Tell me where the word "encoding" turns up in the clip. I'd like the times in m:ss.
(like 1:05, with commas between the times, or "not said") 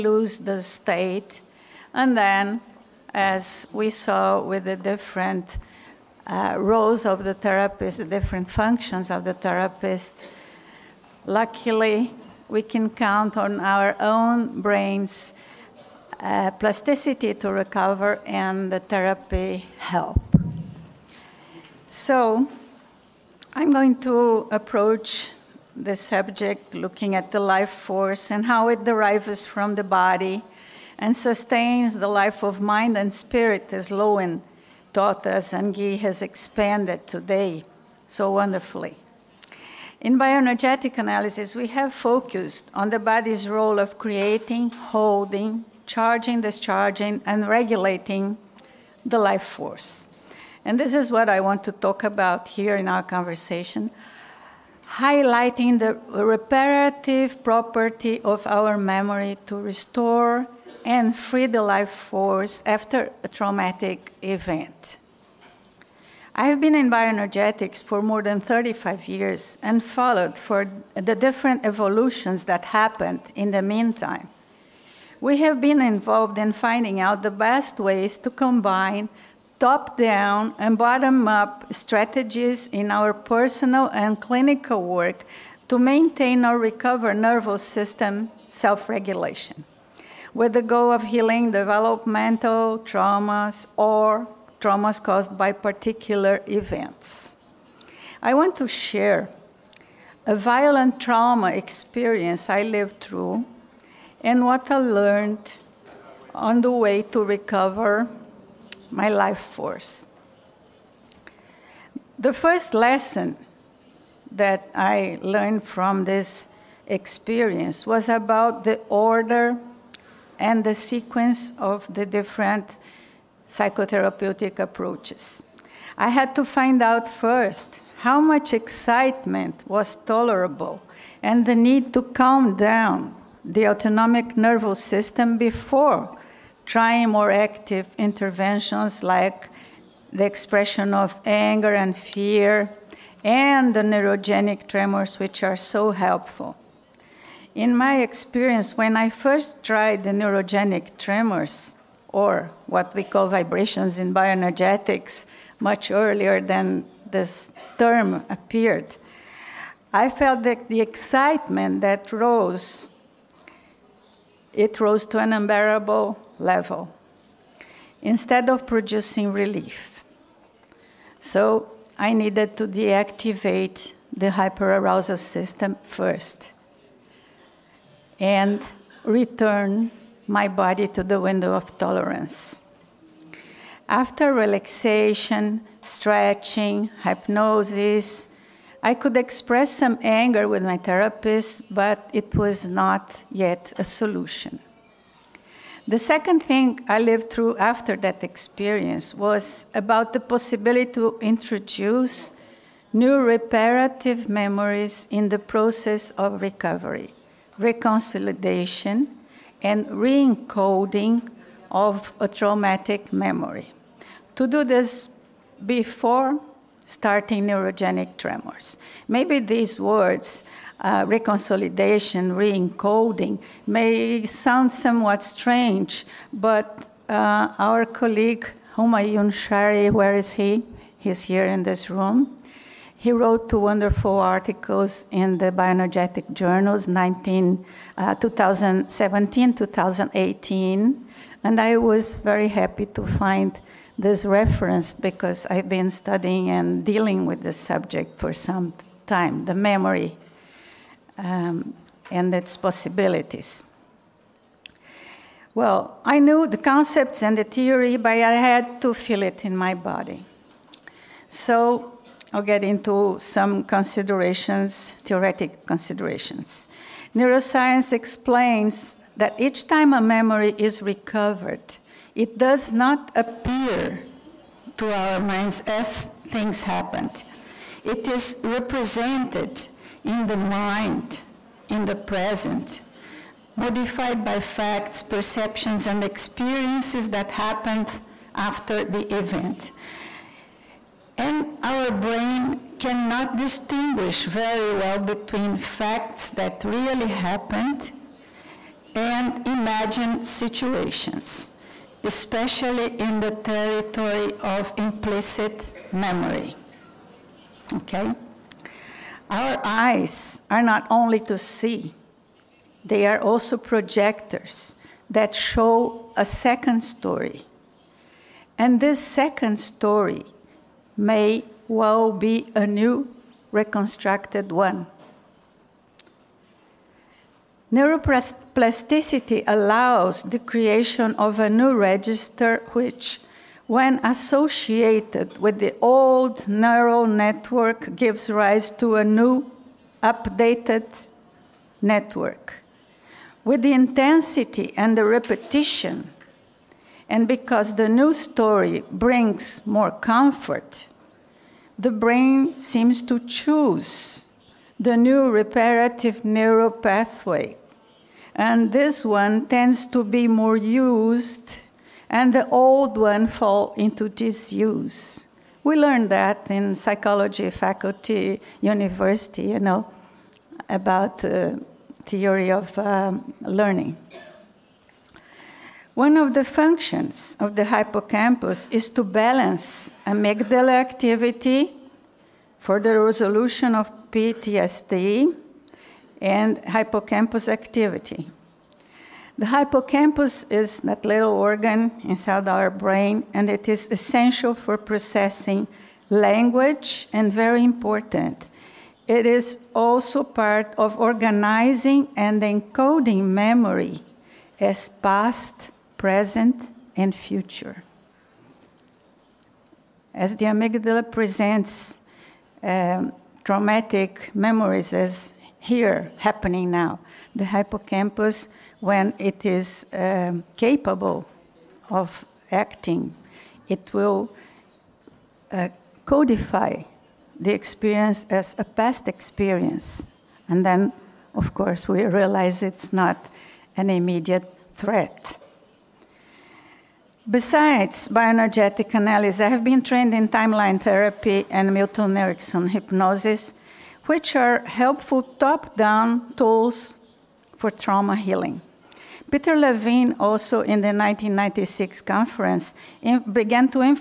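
3:29, 3:42, 6:42.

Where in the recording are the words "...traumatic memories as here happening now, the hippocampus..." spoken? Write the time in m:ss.
6:53.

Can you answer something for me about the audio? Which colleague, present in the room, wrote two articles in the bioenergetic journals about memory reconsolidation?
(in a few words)
Homayoun Shahri.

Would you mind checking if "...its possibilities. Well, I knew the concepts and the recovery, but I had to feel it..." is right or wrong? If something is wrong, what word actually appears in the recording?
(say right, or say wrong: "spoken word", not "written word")
wrong: "theory", not "recovery".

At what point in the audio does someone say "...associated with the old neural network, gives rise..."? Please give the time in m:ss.
5:34.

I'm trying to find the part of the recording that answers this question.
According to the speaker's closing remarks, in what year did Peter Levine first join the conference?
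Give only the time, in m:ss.
7:30.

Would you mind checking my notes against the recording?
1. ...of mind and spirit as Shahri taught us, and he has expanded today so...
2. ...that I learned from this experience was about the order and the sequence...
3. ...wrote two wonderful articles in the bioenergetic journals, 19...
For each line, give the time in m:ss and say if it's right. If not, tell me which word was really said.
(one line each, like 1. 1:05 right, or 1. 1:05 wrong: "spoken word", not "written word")
1. 0:32 wrong: "Lowen", not "Shahri"
2. 1:54 right
3. 3:53 right.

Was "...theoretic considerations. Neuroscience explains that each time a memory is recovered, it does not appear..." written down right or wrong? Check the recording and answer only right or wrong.
right.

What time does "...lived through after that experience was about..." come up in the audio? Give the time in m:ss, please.
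3:17.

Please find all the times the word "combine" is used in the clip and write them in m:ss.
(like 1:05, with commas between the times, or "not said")
1:18.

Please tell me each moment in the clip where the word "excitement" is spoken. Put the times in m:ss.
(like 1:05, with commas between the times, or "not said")
2:08, 2:40.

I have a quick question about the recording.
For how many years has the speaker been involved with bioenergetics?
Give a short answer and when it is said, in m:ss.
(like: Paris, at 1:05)
more than 35 years, at 1:08.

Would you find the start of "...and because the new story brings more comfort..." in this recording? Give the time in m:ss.
5:47.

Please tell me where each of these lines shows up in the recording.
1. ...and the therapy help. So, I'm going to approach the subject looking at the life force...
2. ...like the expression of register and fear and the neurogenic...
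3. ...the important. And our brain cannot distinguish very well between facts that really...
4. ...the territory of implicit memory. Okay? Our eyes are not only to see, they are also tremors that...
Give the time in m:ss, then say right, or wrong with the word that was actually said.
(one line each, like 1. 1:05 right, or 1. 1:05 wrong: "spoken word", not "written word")
1. 0:18 right
2. 2:19 wrong: "anger", not "register"
3. 4:48 wrong: "event", not "important"
4. 5:03 wrong: "projectors", not "tremors".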